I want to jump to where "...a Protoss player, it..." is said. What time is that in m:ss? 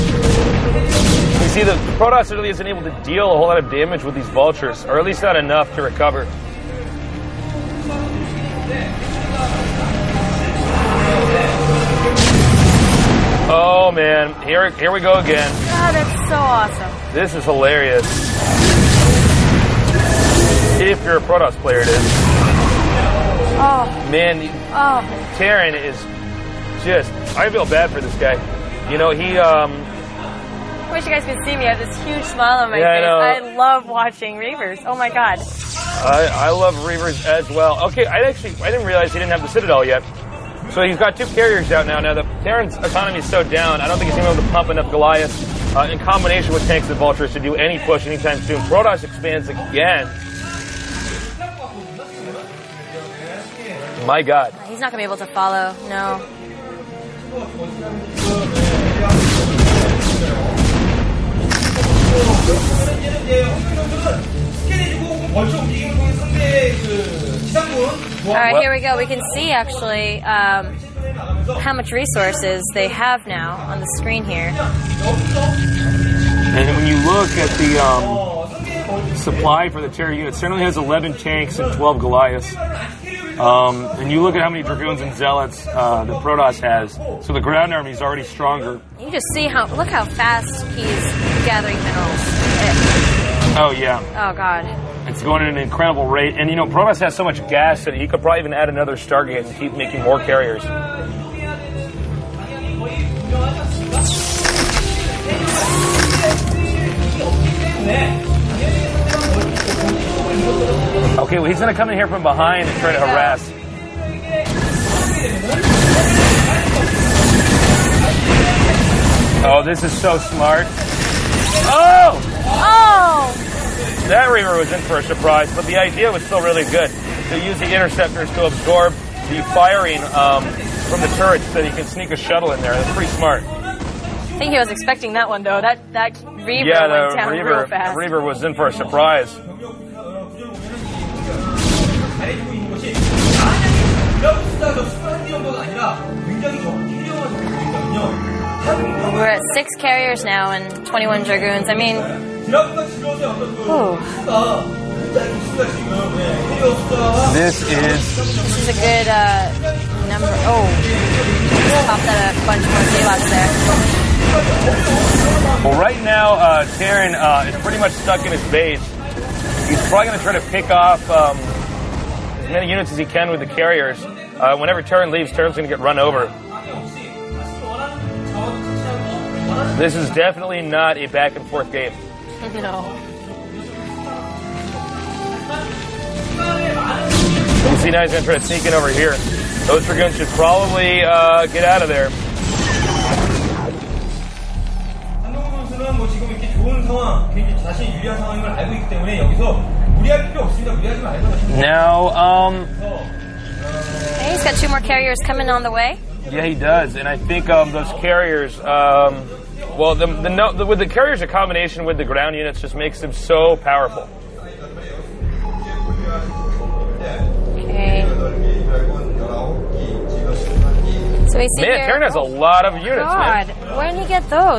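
0:21.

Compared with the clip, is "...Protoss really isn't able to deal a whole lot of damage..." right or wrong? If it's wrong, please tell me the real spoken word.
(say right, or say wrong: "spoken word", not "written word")
right.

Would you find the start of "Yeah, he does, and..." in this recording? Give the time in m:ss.
3:26.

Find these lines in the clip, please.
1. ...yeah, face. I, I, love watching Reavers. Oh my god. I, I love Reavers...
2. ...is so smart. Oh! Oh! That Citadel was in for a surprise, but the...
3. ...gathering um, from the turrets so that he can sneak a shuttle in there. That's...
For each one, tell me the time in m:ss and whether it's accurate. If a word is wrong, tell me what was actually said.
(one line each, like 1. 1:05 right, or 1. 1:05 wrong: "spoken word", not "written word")
1. 0:32 right
2. 1:59 wrong: "Reaver", not "Citadel"
3. 2:09 wrong: "firing", not "gathering".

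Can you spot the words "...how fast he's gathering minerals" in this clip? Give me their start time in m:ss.
1:29.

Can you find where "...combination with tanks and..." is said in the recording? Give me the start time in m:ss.
0:45.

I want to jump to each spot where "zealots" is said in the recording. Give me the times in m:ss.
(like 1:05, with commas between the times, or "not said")
1:25, 2:42.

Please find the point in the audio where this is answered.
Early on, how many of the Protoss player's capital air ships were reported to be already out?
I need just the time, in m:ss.
0:41.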